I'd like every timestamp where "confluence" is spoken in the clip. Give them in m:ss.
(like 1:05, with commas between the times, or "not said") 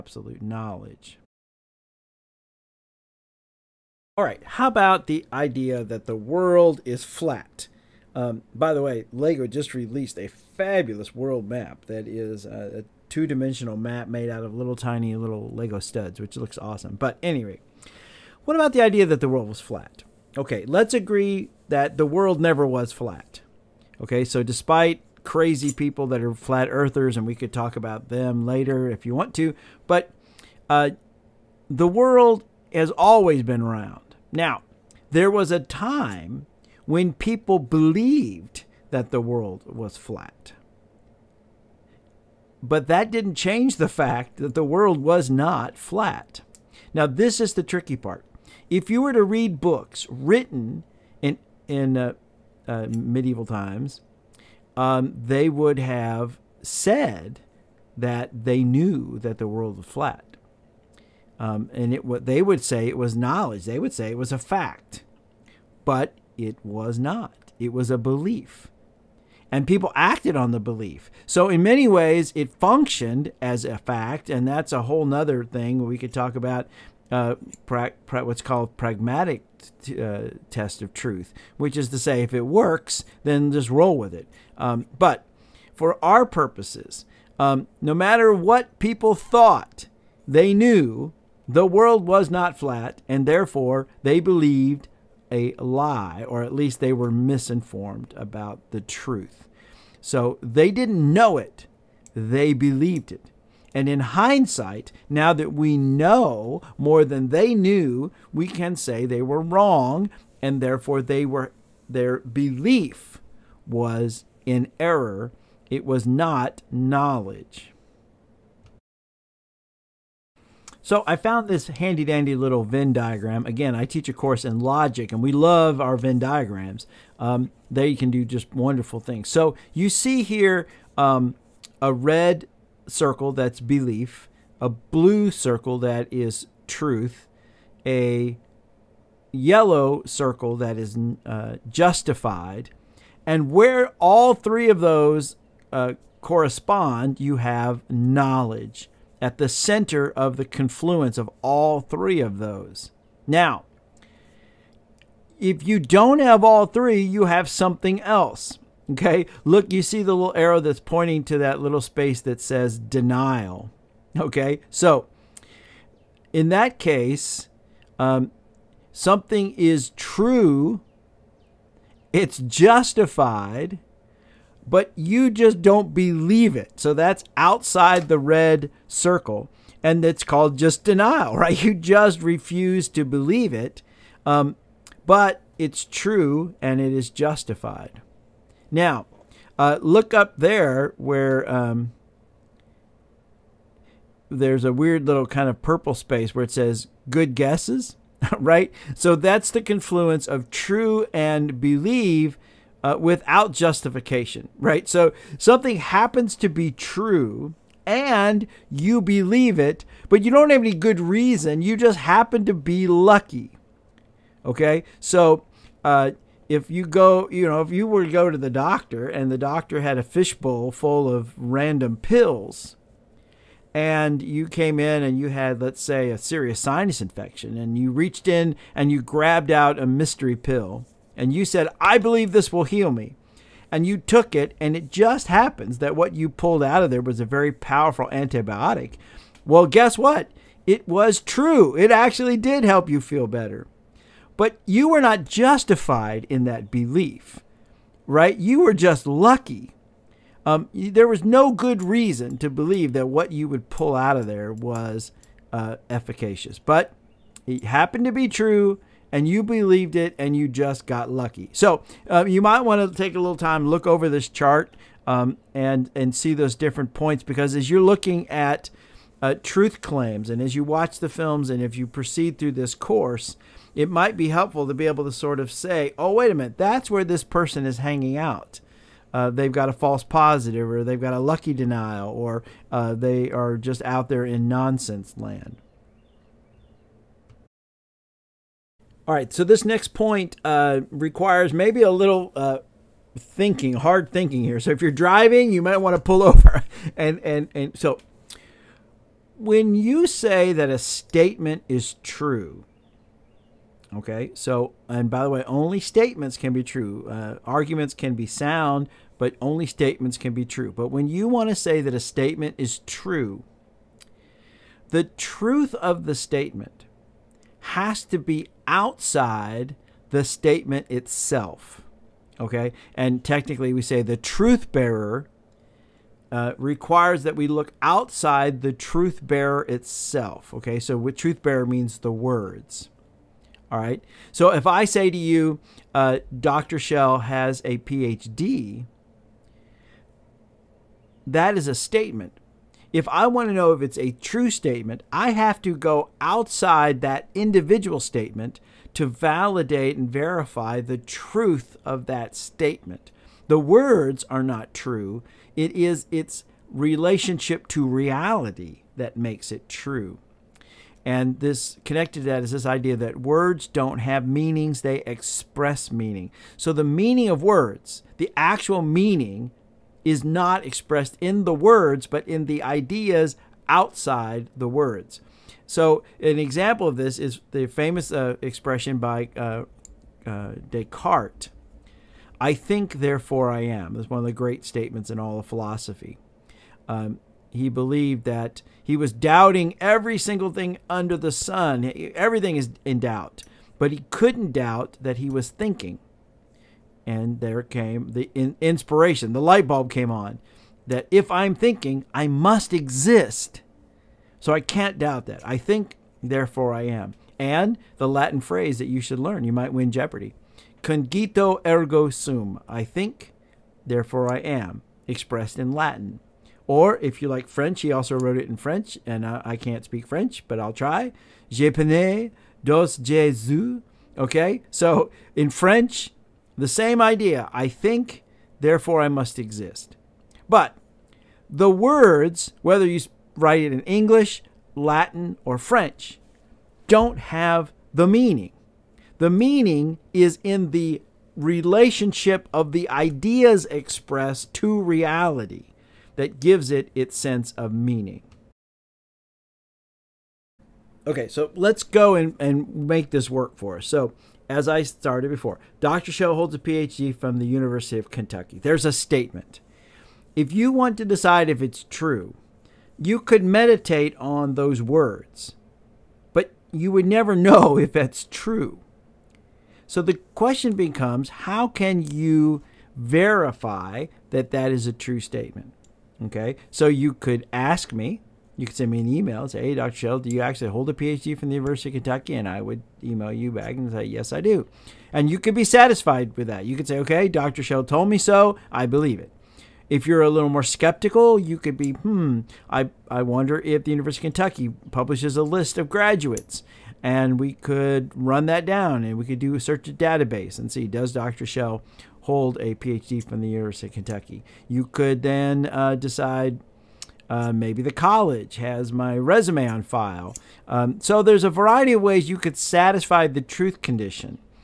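2:30, 3:19.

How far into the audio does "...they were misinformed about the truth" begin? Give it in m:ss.
1:36.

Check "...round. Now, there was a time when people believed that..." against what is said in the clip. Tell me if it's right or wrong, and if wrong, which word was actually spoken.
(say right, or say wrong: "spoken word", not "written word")
right.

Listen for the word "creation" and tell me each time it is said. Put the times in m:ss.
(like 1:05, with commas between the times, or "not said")
not said.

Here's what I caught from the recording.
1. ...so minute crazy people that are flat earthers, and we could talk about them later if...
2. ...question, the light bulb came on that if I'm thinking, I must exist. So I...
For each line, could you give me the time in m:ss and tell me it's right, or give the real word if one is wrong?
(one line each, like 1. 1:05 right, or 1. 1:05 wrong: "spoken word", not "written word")
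1. 0:24 wrong: "despite", not "minute"
2. 6:38 wrong: "inspiration", not "question".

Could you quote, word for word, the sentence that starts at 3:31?
You just happen to be lucky.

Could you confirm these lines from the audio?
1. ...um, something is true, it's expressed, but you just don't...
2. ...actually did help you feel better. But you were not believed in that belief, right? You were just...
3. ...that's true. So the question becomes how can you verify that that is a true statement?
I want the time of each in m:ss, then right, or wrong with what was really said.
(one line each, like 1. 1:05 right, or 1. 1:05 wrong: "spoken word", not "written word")
1. 2:47 wrong: "justified", not "expressed"
2. 4:01 wrong: "justified", not "believed"
3. 7:47 right.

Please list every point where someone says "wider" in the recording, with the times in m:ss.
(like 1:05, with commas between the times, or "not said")
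not said.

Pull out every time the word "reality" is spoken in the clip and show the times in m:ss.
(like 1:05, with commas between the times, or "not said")
5:57, 7:24.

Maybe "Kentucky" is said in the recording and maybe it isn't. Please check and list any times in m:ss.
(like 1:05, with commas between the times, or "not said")
7:38, 8:01, 8:14, 8:23.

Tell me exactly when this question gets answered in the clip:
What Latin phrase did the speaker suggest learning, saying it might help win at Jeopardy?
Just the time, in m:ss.
6:50.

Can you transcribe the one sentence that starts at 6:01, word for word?
And this connected to that is this idea that words don't have meanings, they express meaning.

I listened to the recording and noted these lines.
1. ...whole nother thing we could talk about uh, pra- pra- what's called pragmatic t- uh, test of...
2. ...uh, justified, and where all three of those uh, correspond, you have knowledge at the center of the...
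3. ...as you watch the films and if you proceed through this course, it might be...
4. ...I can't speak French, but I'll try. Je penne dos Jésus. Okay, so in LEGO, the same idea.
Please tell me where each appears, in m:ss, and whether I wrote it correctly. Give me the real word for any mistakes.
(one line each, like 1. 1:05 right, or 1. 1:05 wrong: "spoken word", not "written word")
1. 1:14 right
2. 2:21 right
3. 4:30 right
4. 6:59 wrong: "French", not "LEGO".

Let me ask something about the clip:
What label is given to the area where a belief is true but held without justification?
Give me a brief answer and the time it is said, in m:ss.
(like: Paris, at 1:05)
Good guesses, at 3:17.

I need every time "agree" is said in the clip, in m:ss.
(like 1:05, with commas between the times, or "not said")
0:20.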